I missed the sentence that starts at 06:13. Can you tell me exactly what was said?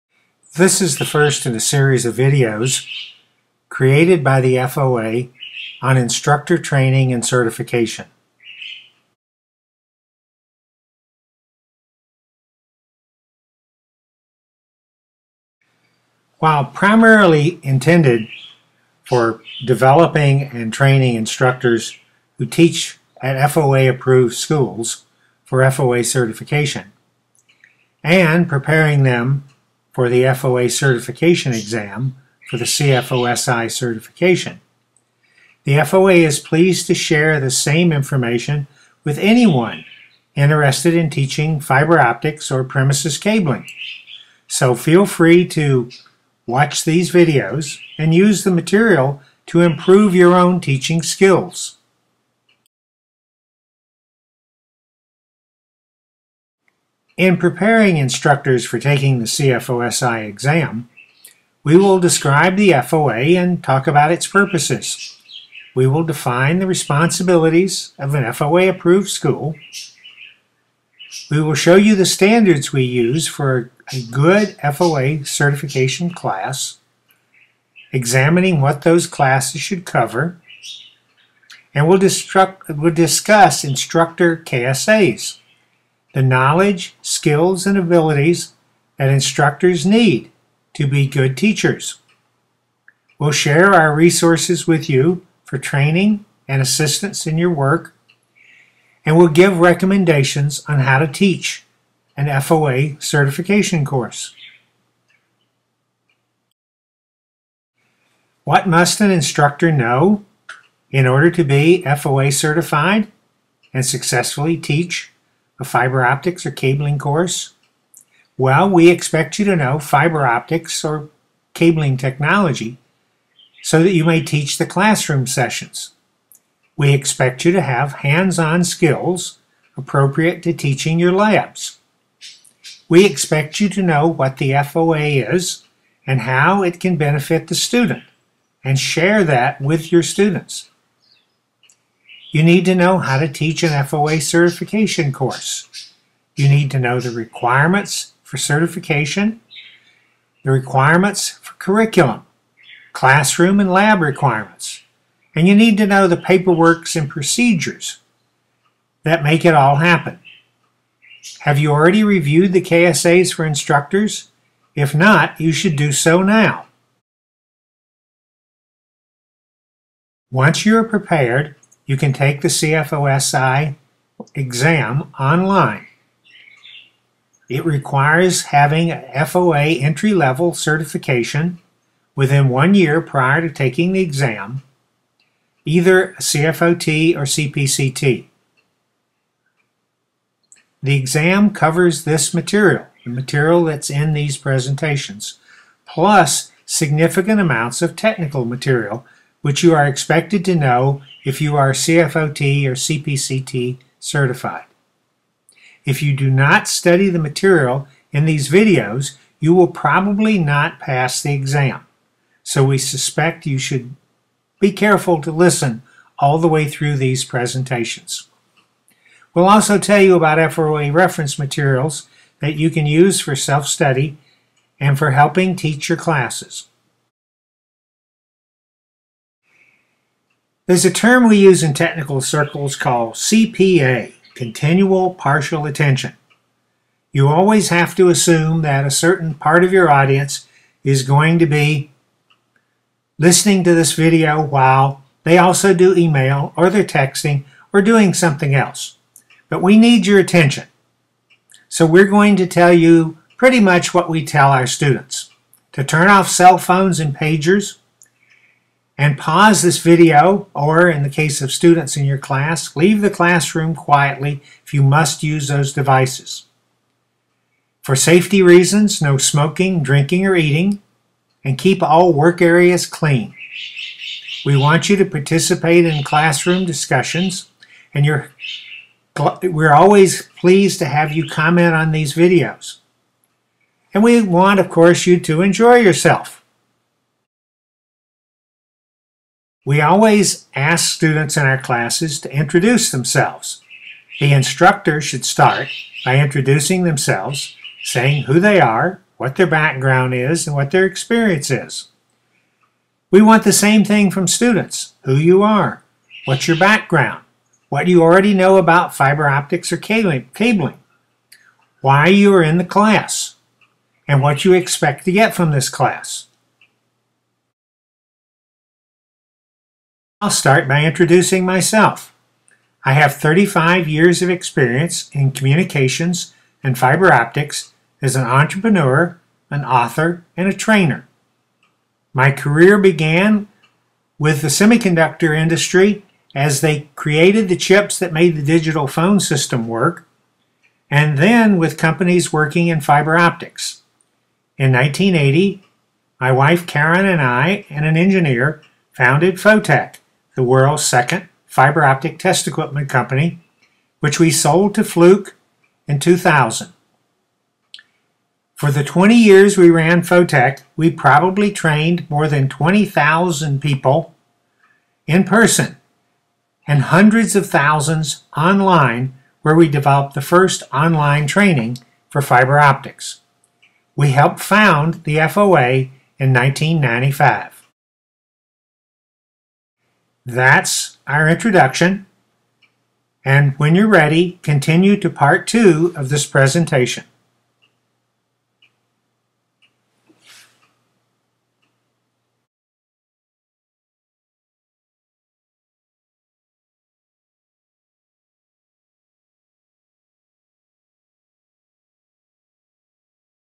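We helped found the FOA in 1995.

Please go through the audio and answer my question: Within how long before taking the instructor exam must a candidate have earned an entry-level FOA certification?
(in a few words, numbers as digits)
one year.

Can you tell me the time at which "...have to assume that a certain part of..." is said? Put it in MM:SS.
03:57.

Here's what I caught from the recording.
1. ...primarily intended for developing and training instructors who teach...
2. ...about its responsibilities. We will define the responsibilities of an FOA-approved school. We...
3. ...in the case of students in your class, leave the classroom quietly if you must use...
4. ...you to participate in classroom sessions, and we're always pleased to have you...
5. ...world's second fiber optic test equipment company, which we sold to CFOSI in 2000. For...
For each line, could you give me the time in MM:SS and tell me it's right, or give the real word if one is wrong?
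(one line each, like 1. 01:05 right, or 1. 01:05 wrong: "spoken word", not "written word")
1. 00:16 right
2. 01:03 wrong: "purposes", not "responsibilities"
3. 04:20 right
4. 04:34 wrong: "discussions", not "sessions"
5. 05:50 wrong: "Fluke", not "CFOSI".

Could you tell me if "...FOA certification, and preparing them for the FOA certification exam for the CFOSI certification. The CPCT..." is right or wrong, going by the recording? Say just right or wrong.
wrong.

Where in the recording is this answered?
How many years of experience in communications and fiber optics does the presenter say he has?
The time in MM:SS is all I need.
05:23.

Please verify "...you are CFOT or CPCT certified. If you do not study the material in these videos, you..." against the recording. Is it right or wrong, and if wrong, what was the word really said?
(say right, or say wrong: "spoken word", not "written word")
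right.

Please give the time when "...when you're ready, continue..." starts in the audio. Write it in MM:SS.
06:23.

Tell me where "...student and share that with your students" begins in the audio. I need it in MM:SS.
02:17.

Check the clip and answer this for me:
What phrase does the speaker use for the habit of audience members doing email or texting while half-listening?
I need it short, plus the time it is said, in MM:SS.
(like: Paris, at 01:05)
continual partial attention, at 03:54.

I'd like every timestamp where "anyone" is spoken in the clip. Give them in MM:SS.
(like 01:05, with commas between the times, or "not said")
00:39.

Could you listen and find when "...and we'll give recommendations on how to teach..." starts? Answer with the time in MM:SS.
01:39.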